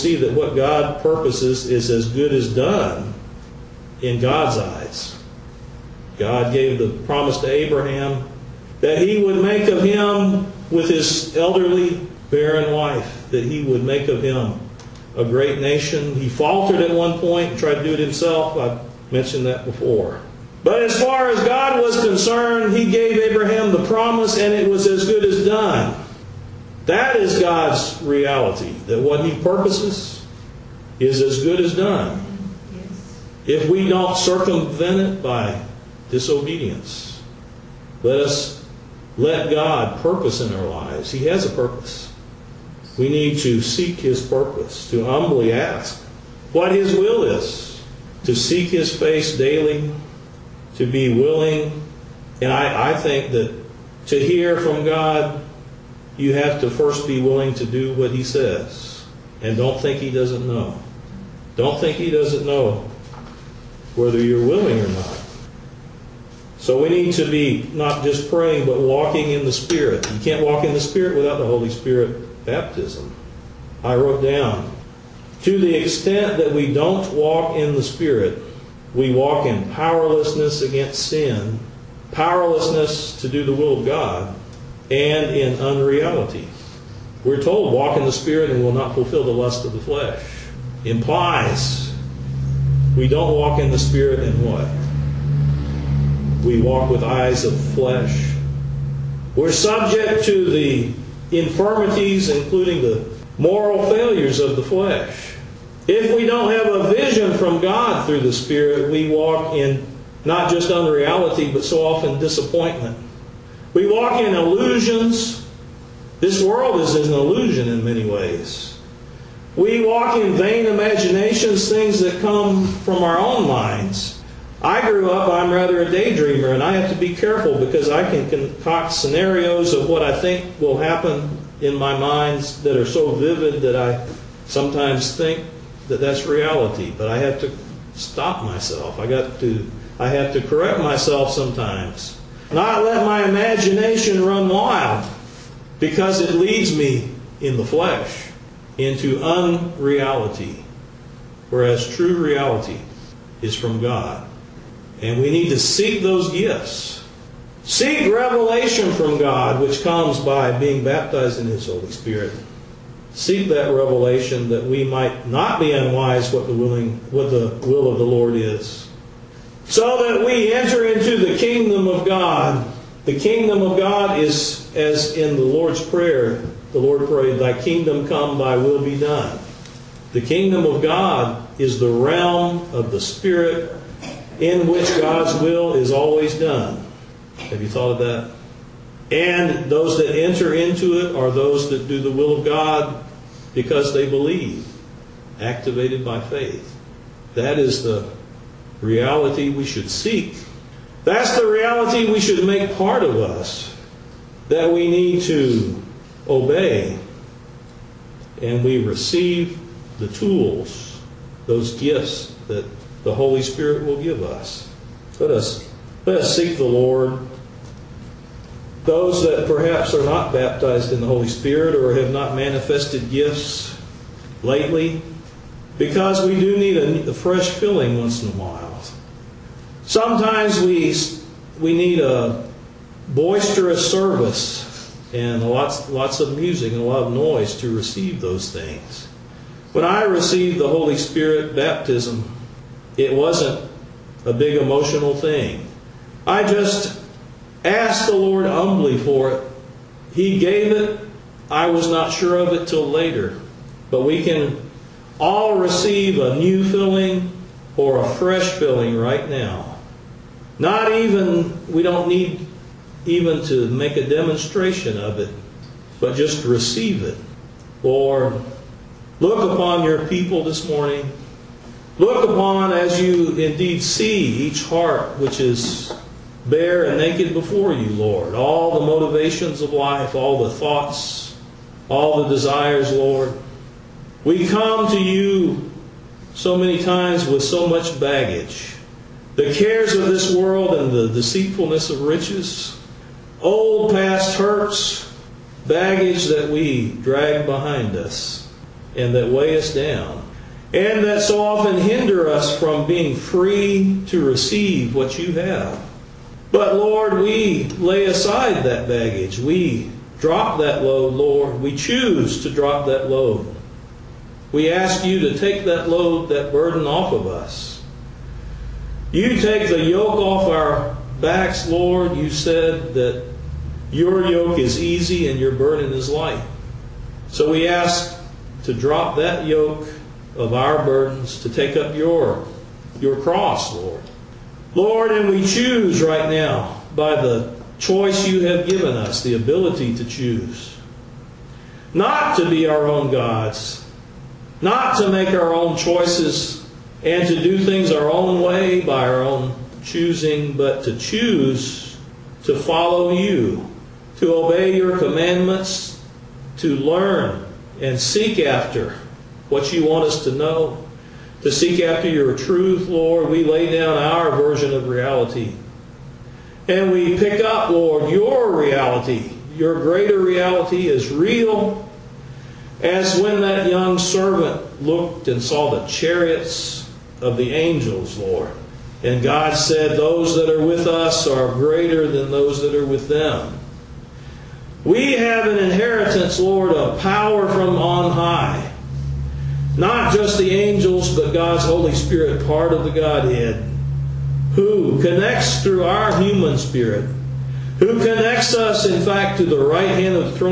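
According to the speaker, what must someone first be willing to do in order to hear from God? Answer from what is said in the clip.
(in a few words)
Do what he says.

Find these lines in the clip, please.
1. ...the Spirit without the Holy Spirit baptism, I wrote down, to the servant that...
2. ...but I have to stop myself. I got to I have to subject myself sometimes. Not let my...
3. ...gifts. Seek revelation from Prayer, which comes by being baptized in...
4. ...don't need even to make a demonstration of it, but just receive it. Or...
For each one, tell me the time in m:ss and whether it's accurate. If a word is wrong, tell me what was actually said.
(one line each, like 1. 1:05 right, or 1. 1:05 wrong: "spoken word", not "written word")
1. 1:10 wrong: "extent", not "servant"
2. 2:16 wrong: "correct", not "subject"
3. 2:36 wrong: "God", not "Prayer"
4. 4:21 right.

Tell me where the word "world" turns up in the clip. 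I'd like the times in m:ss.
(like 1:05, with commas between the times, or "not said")
1:56, 4:50.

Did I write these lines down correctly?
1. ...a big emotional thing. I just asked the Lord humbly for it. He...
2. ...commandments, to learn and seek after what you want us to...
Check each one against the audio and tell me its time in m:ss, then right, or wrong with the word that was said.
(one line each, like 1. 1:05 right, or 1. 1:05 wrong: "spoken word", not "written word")
1. 4:04 right
2. 5:54 right.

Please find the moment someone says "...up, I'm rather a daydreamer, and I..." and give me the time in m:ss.
2:05.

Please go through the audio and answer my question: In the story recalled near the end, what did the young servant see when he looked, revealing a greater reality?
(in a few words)
Chariots of the angels.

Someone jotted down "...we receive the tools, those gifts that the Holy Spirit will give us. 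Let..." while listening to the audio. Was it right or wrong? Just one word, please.
right.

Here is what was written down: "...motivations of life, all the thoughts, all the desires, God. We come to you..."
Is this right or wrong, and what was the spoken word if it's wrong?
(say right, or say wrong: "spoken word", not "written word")
wrong: "Lord", not "God".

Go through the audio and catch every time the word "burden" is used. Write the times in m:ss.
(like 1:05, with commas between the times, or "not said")
5:16, 5:25, 5:30.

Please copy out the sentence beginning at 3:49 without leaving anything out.
Sometimes we, we need a boisterous service and lots, lots of music and a lot of noise to receive those things.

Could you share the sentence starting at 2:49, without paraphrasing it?
So that we enter into the kingdom of God.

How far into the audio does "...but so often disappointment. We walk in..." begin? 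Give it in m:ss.
1:51.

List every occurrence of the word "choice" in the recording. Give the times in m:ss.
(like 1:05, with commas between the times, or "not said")
5:37, 5:45.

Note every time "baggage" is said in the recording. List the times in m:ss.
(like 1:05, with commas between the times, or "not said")
4:47, 4:55, 5:08.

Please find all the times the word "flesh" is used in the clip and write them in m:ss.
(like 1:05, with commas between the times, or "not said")
1:29, 1:37, 1:44, 2:27.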